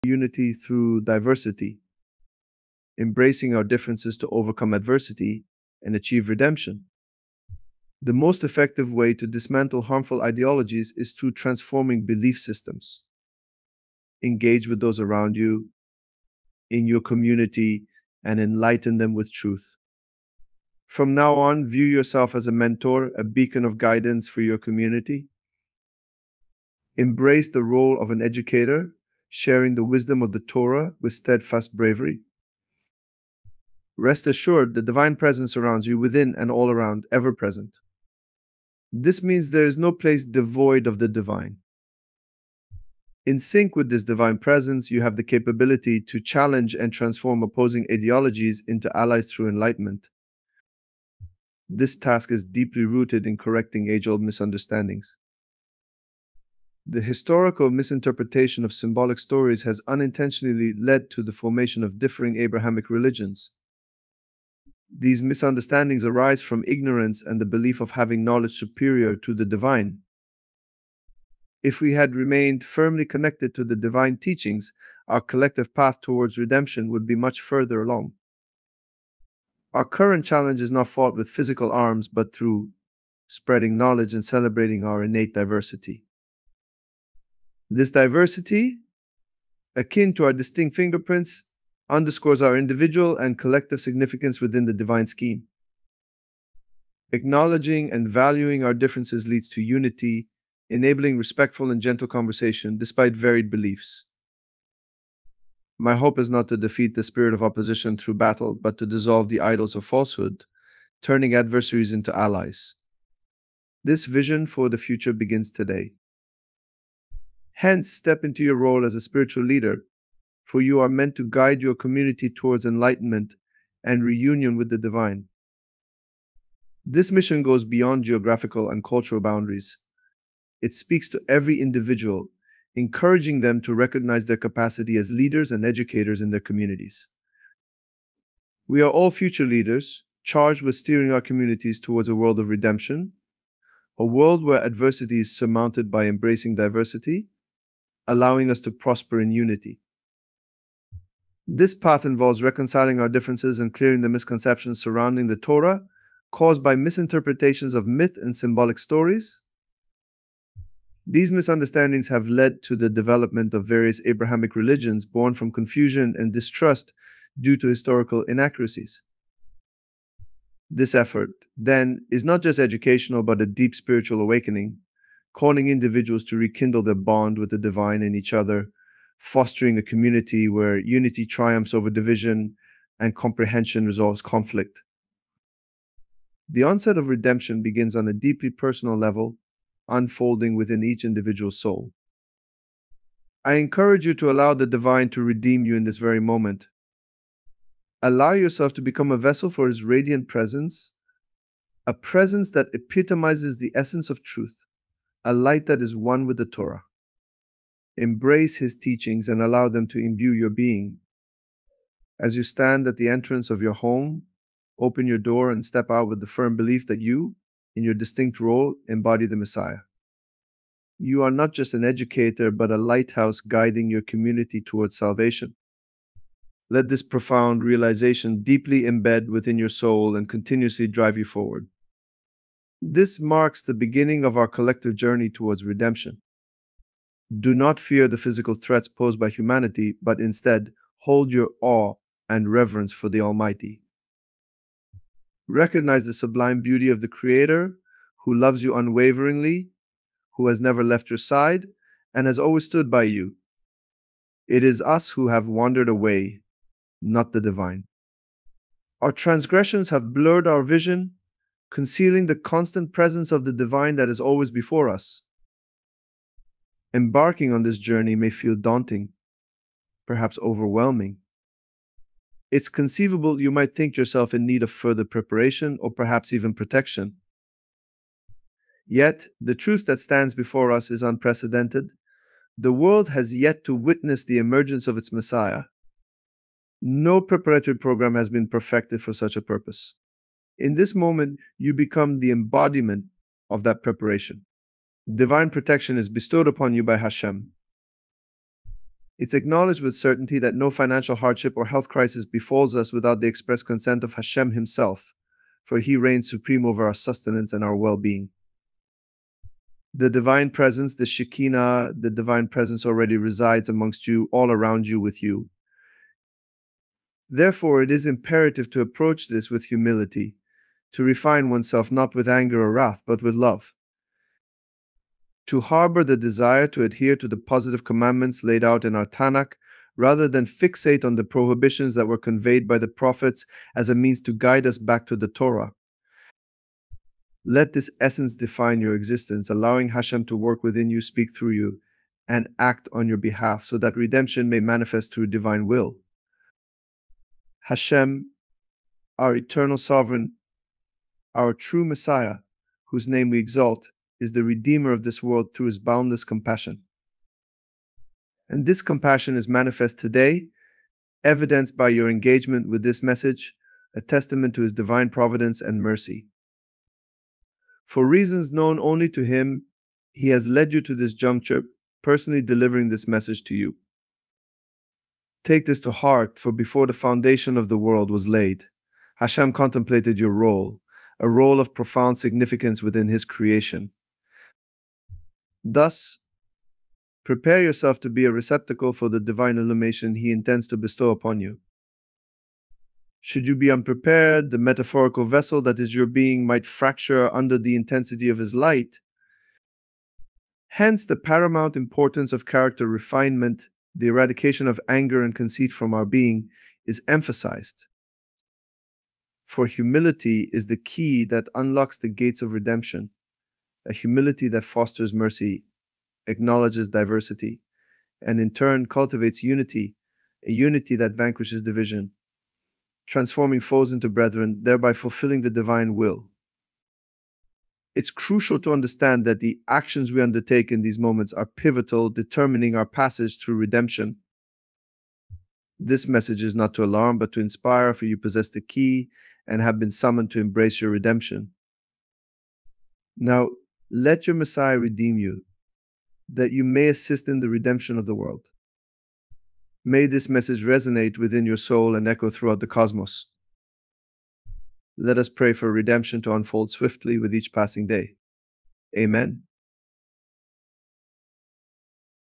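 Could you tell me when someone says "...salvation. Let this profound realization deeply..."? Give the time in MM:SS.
03:44.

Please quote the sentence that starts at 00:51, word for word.
This task is deeply rooted in correcting age old misunderstandings.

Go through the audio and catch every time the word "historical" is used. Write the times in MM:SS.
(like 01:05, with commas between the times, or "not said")
00:57, 02:47.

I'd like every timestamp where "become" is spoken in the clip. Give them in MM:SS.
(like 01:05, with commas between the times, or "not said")
03:18, 04:51.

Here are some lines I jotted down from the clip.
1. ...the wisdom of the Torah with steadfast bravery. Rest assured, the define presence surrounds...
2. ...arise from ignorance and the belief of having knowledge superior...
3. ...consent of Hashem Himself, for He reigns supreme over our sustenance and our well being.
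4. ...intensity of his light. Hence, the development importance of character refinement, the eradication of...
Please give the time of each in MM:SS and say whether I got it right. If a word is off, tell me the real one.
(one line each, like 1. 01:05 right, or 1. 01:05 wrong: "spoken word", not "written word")
1. 00:29 wrong: "divine", not "define"
2. 01:06 right
3. 05:03 right
4. 06:37 wrong: "paramount", not "development".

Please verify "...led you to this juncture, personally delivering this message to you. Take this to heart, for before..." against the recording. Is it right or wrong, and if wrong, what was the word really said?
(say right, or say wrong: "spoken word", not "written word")
right.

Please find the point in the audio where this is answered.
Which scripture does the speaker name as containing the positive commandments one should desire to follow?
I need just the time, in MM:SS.
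05:29.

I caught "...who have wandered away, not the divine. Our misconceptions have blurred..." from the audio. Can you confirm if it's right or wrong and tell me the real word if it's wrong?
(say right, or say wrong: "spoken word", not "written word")
wrong: "transgressions", not "misconceptions".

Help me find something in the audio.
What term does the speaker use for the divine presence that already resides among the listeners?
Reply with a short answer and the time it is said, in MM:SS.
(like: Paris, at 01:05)
Shekinah, at 05:11.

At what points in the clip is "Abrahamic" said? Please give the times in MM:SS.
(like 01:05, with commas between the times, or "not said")
01:02, 02:44.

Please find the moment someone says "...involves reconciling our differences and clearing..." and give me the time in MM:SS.
02:32.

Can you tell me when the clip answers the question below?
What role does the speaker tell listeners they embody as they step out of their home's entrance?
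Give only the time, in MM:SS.
03:38.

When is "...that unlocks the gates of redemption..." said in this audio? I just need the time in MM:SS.
06:51.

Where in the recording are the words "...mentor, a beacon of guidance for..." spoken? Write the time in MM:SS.
00:22.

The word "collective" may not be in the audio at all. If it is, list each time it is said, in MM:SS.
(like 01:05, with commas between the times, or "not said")
01:15, 01:33, 03:54.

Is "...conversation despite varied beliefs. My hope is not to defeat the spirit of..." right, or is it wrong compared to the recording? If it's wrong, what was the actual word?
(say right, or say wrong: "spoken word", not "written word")
right.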